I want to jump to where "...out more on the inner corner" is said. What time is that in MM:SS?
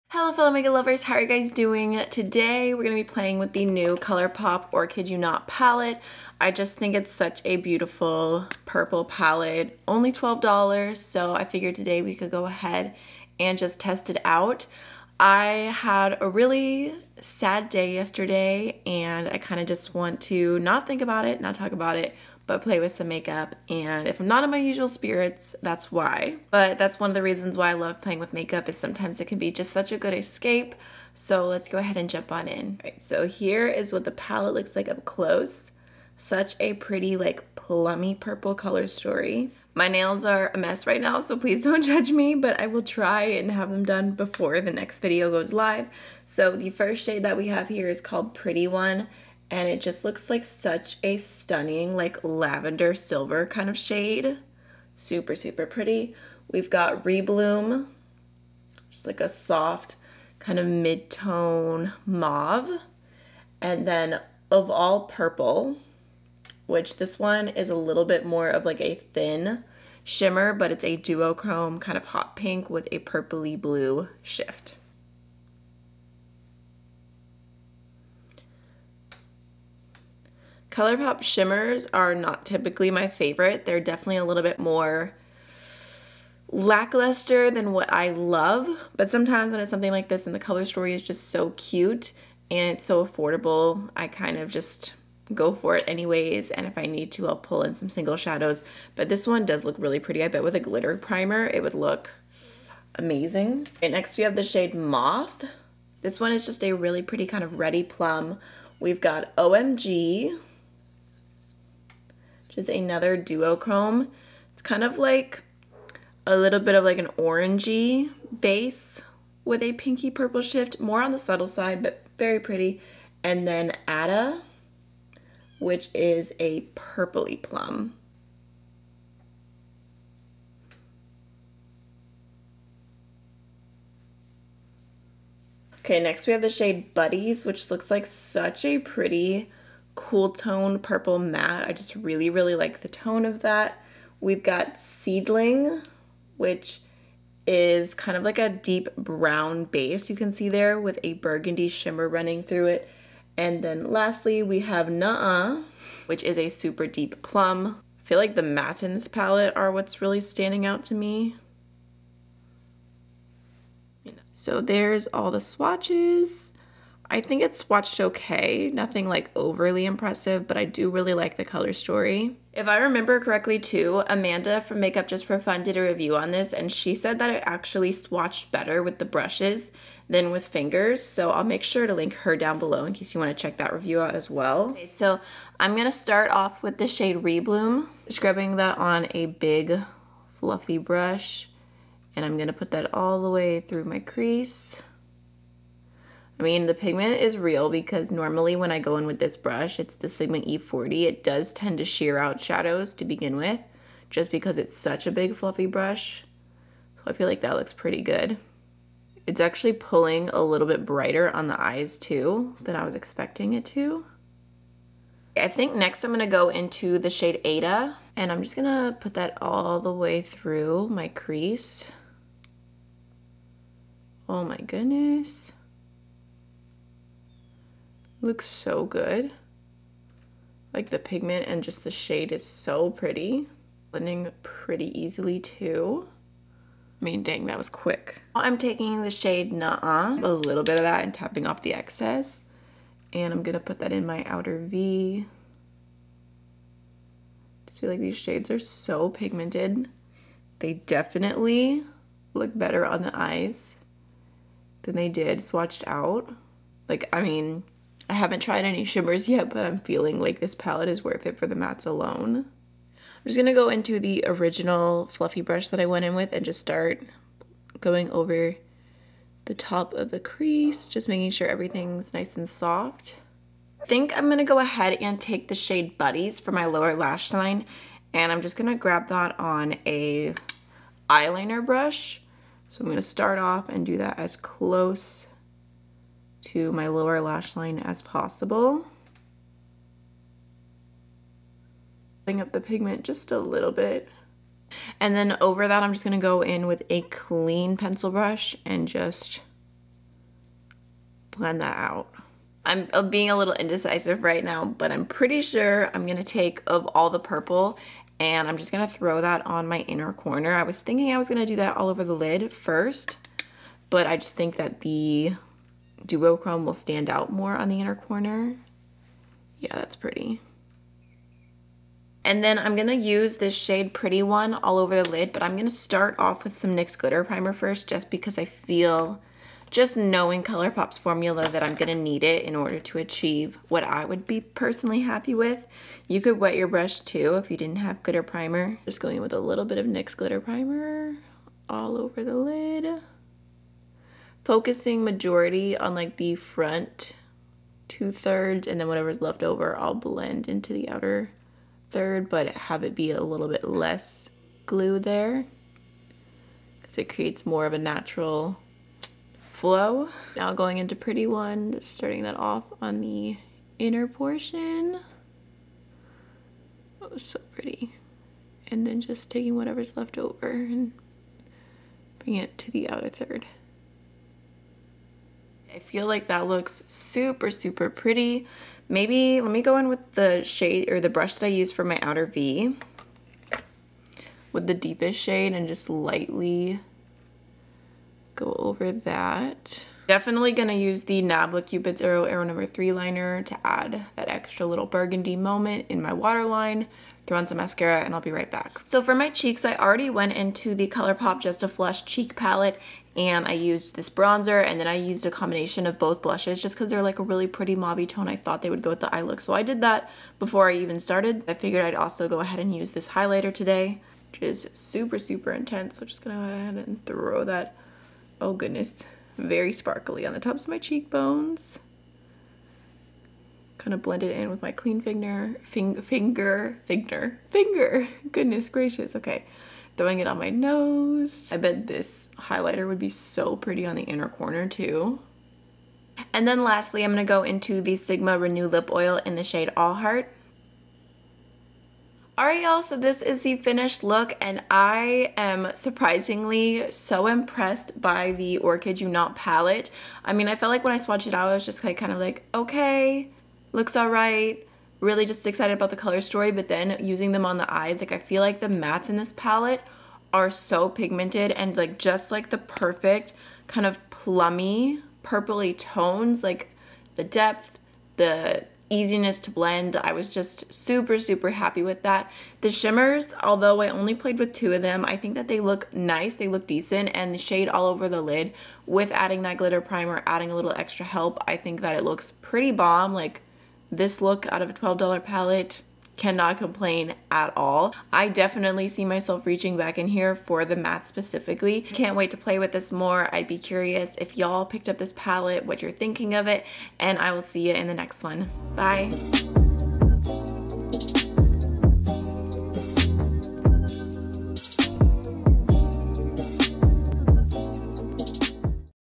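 05:17.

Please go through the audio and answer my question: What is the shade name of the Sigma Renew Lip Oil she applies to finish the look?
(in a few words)
All Heart.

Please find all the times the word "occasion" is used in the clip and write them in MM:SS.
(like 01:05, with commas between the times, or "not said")
not said.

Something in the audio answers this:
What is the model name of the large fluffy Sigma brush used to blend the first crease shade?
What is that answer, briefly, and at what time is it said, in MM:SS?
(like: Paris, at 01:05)
E40, at 03:20.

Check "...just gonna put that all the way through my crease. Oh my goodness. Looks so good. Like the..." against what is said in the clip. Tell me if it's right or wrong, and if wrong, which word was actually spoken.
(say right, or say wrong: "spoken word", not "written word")
right.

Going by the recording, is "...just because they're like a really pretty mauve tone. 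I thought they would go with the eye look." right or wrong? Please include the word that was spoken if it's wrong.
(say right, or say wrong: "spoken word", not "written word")
right.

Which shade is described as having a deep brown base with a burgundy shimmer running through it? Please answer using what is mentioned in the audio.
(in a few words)
Seedling.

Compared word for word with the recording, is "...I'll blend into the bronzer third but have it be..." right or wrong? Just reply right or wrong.
wrong.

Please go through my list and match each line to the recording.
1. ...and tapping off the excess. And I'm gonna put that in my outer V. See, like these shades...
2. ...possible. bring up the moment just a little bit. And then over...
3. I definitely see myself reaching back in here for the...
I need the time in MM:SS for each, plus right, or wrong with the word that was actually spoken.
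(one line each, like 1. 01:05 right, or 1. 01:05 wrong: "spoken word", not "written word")
1. 04:01 right
2. 04:48 wrong: "pigment", not "moment"
3. 08:08 right.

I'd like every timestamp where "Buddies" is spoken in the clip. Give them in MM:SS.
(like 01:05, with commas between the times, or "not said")
02:16, 04:35.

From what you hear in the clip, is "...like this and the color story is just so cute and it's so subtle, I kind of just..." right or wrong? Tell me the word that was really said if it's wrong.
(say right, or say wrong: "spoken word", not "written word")
wrong: "affordable", not "subtle".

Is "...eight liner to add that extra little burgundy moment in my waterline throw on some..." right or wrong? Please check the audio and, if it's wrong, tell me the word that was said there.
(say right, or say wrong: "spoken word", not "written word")
wrong: "three", not "eight".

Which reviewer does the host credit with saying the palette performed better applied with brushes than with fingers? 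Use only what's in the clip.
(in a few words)
Amanda.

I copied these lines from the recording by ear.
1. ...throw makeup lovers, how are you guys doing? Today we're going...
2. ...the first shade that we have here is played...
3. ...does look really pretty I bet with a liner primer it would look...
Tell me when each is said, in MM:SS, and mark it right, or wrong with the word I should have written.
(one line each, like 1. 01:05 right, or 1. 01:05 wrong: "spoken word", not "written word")
1. 00:00 wrong: "fellow", not "throw"
2. 00:46 wrong: "called", not "played"
3. 01:39 wrong: "glitter", not "liner".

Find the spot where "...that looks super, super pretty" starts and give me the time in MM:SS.
06:16.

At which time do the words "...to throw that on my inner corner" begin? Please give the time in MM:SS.
05:08.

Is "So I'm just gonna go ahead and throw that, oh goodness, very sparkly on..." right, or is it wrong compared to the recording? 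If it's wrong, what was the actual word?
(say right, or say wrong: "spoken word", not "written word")
right.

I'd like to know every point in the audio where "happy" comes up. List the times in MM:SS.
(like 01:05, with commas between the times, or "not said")
05:35, 07:51.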